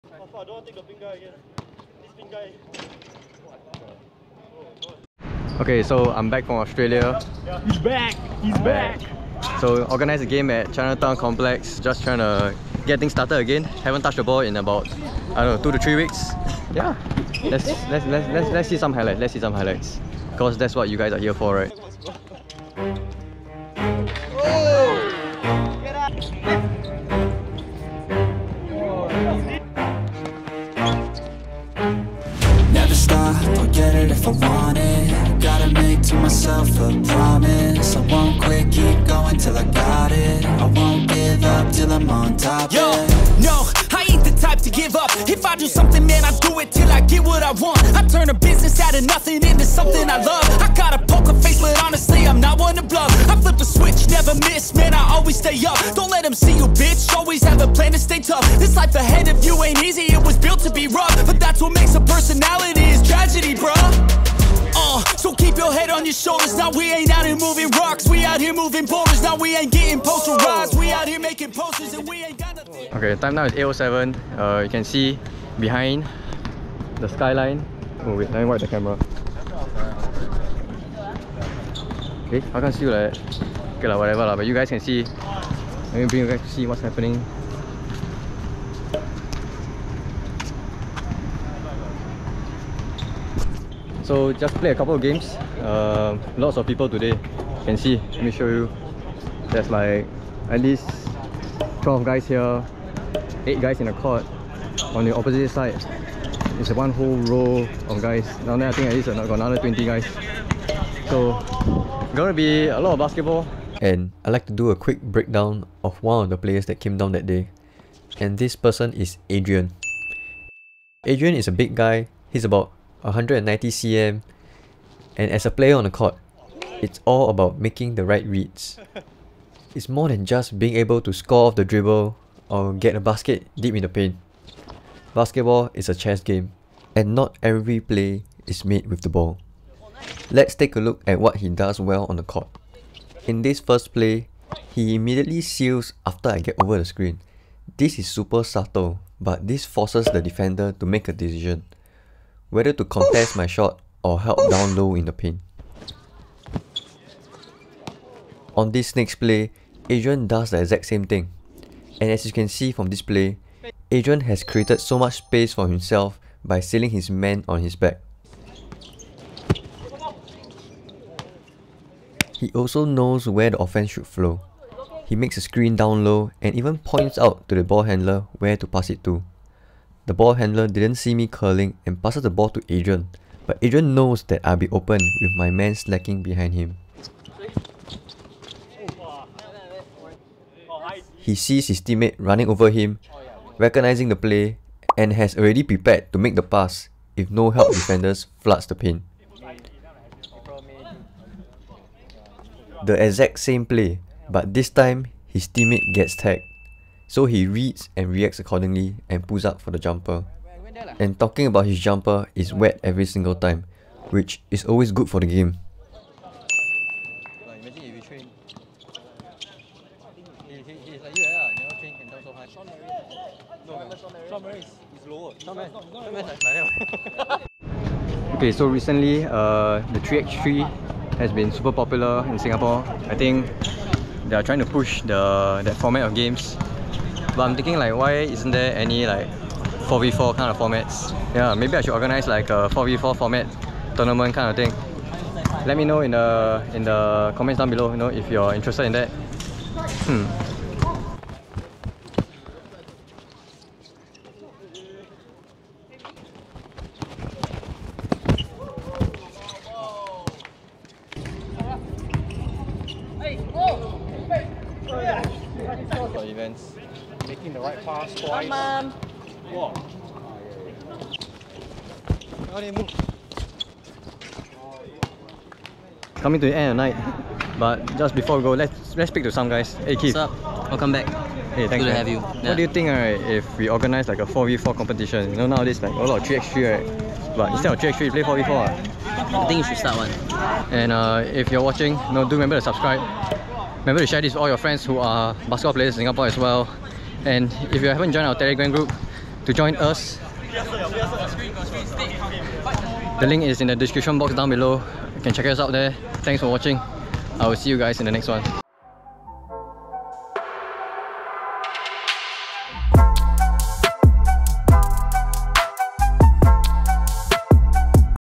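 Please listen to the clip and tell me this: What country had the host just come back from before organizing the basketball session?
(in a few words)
Australia.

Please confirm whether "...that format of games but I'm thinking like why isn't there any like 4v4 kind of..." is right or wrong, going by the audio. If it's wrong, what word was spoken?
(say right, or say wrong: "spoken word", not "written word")
right.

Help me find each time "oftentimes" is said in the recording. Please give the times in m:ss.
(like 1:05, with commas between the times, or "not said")
not said.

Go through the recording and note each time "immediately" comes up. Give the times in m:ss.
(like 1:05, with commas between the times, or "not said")
2:24.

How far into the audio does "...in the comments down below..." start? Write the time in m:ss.
4:06.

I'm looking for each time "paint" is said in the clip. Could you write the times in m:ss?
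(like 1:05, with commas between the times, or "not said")
2:13, 2:35.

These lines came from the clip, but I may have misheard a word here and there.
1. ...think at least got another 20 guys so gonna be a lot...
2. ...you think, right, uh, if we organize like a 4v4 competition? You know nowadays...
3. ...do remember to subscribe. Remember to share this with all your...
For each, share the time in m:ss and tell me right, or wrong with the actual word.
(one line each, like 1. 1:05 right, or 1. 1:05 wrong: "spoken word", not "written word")
1. 1:48 right
2. 4:42 right
3. 4:52 right.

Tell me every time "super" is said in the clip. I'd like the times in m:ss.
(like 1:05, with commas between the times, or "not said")
2:28, 3:51.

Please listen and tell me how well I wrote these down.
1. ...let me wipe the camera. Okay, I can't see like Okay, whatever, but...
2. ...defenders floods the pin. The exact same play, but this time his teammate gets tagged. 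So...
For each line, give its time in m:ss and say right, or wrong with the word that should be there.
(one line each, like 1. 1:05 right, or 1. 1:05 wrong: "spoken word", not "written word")
1. 1:18 right
2. 3:17 right.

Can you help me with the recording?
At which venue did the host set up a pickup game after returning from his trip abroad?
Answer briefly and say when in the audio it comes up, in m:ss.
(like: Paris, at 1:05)
Chinatown Complex, at 0:10.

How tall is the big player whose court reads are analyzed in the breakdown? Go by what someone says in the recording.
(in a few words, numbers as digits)
190 cm.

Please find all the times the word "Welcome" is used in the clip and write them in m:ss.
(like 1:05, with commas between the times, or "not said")
4:40.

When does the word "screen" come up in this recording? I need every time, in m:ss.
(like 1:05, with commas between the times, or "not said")
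2:26, 2:55.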